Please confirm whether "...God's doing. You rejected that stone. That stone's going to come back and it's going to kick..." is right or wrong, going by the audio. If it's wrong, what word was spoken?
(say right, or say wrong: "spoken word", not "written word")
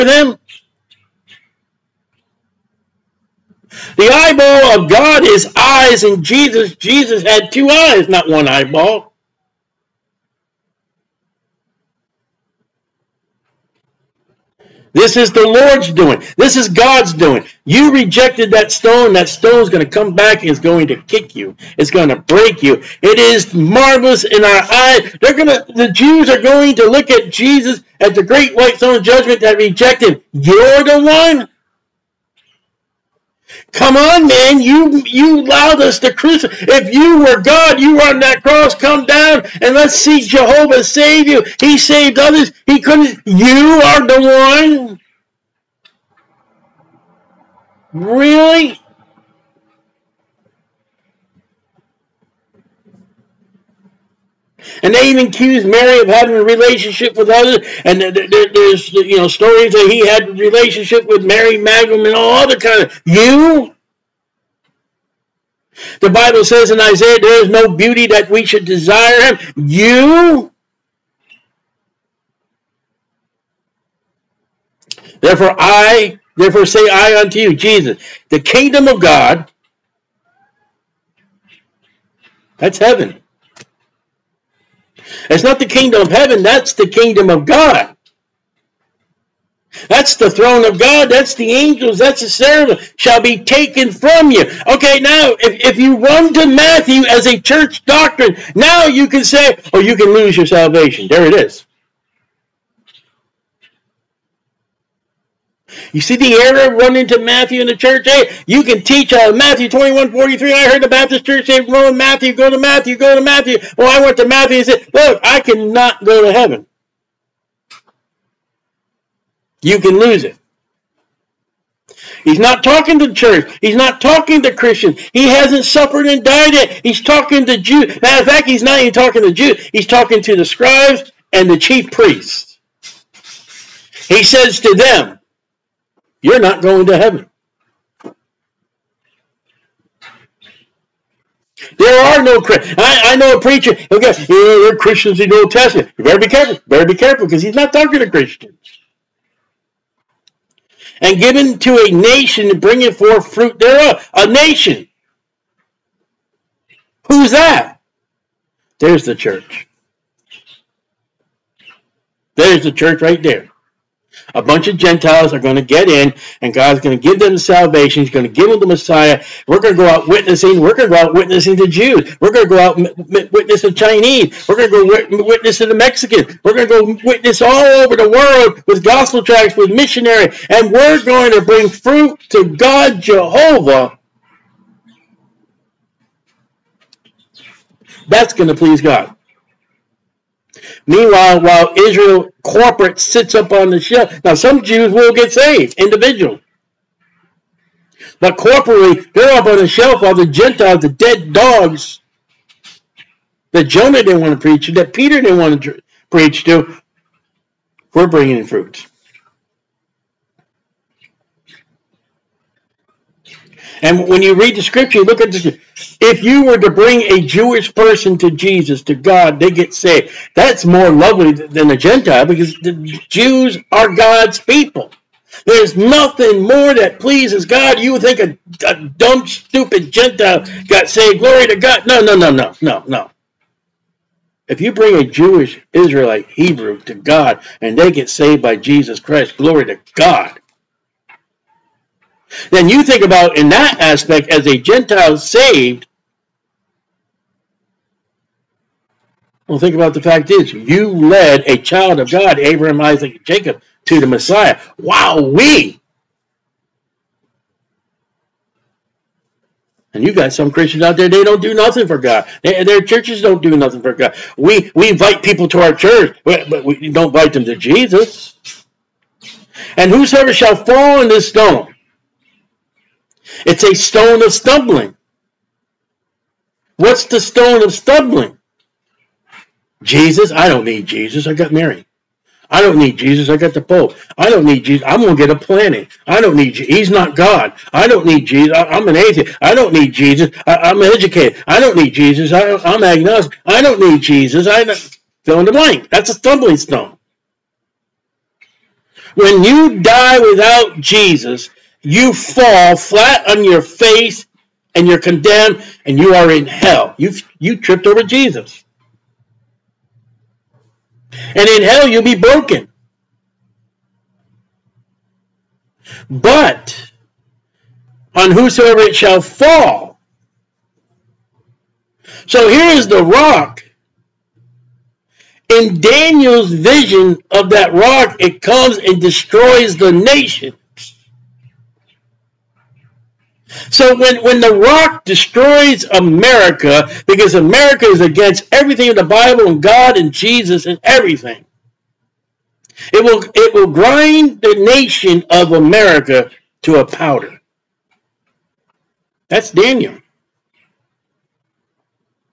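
right.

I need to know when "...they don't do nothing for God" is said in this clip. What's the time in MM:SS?
04:21.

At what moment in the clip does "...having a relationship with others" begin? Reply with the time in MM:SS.
00:56.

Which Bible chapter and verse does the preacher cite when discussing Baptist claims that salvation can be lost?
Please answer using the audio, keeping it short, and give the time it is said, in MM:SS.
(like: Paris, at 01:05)
Matthew 21:43, at 01:49.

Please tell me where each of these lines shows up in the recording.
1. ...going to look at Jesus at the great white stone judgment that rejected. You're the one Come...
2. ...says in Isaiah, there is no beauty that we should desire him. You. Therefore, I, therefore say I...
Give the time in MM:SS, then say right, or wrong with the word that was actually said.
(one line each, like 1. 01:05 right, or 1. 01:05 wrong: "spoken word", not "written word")
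1. 00:26 right
2. 01:06 right.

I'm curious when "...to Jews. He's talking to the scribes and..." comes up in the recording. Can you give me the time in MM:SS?
02:09.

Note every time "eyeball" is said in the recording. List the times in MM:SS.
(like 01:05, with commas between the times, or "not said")
00:04, 00:08.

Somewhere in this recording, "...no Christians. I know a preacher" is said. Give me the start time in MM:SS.
02:22.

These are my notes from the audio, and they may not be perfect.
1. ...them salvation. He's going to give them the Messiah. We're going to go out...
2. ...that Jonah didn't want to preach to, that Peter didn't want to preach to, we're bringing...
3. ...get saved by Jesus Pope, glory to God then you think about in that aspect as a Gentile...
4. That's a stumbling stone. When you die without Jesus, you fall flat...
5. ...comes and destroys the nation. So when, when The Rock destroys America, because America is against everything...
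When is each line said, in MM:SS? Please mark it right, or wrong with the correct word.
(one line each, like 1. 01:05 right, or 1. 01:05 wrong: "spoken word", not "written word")
1. 02:47 right
2. 03:23 right
3. 03:57 wrong: "Christ", not "Pope"
4. 04:55 right
5. 05:28 right.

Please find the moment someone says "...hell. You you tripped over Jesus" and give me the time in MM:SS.
05:06.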